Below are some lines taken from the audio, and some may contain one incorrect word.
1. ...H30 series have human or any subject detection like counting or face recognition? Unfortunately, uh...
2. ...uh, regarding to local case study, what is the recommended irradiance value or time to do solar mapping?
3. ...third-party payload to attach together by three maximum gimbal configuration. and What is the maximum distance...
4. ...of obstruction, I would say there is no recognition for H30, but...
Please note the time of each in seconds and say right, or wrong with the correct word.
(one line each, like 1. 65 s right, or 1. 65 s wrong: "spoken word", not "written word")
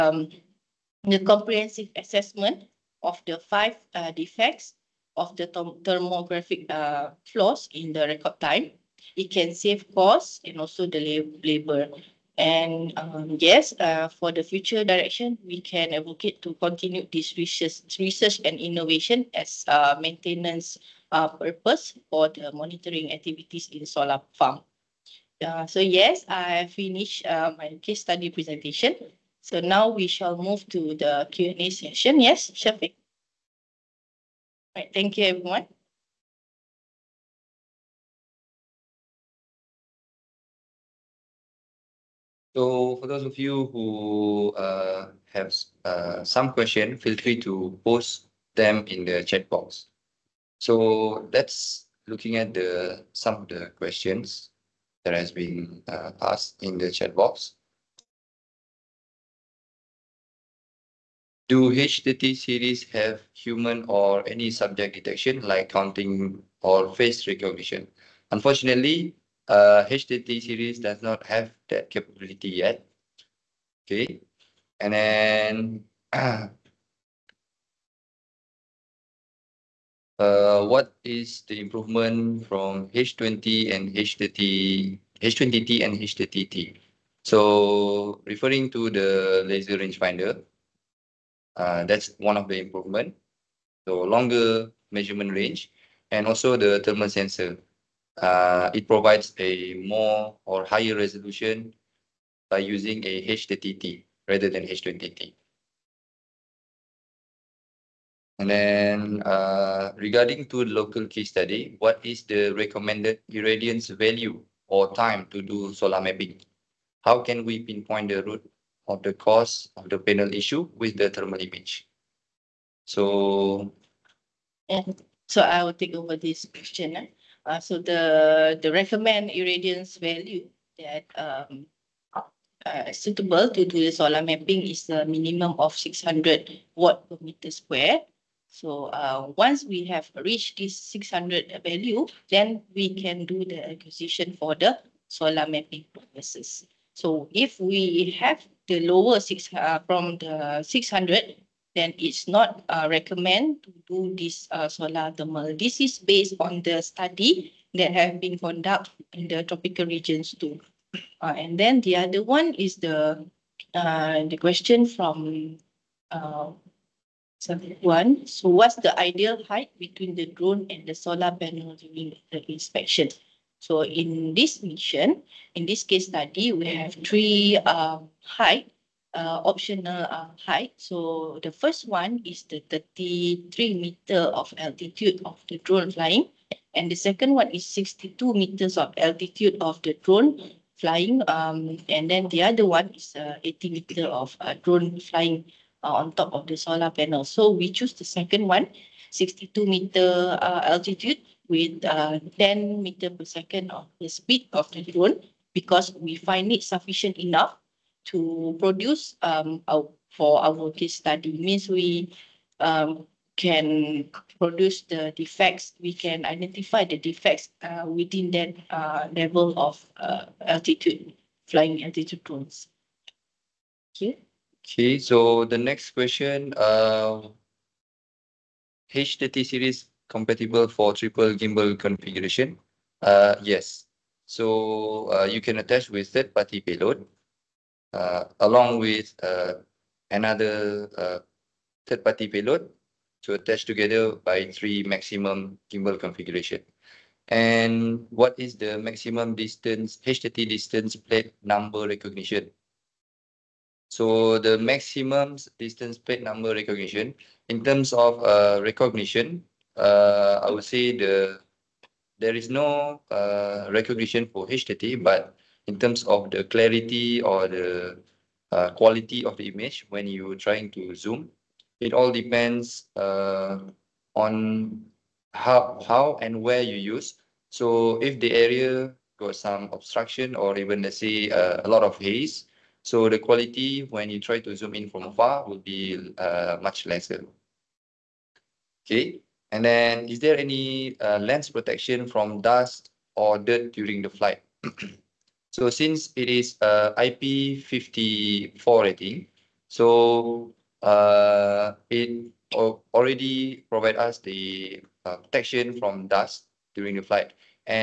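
1. 61 s right
2. 109 s right
3. 241 s right
4. 257 s wrong: "recognition", not "obstruction".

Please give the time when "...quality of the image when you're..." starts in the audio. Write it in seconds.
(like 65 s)
268 s.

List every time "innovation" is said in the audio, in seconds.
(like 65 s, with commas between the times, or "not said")
18 s.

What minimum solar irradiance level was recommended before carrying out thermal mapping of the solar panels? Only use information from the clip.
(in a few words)
600 watts per square meter.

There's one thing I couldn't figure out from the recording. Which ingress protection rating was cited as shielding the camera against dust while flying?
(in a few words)
IP54.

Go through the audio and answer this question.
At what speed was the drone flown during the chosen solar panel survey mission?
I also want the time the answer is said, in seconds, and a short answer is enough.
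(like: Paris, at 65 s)
10 meters per second, at 202 s.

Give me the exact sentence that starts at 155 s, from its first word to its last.
This is based on the study that have been conducted in the tropical regions too.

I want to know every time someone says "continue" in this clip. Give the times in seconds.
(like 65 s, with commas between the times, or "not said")
16 s.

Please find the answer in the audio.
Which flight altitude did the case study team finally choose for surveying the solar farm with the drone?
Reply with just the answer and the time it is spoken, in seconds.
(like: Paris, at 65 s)
62 meters, at 199 s.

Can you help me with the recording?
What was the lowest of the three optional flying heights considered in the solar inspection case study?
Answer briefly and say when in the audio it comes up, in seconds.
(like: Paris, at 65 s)
33 meters, at 182 s.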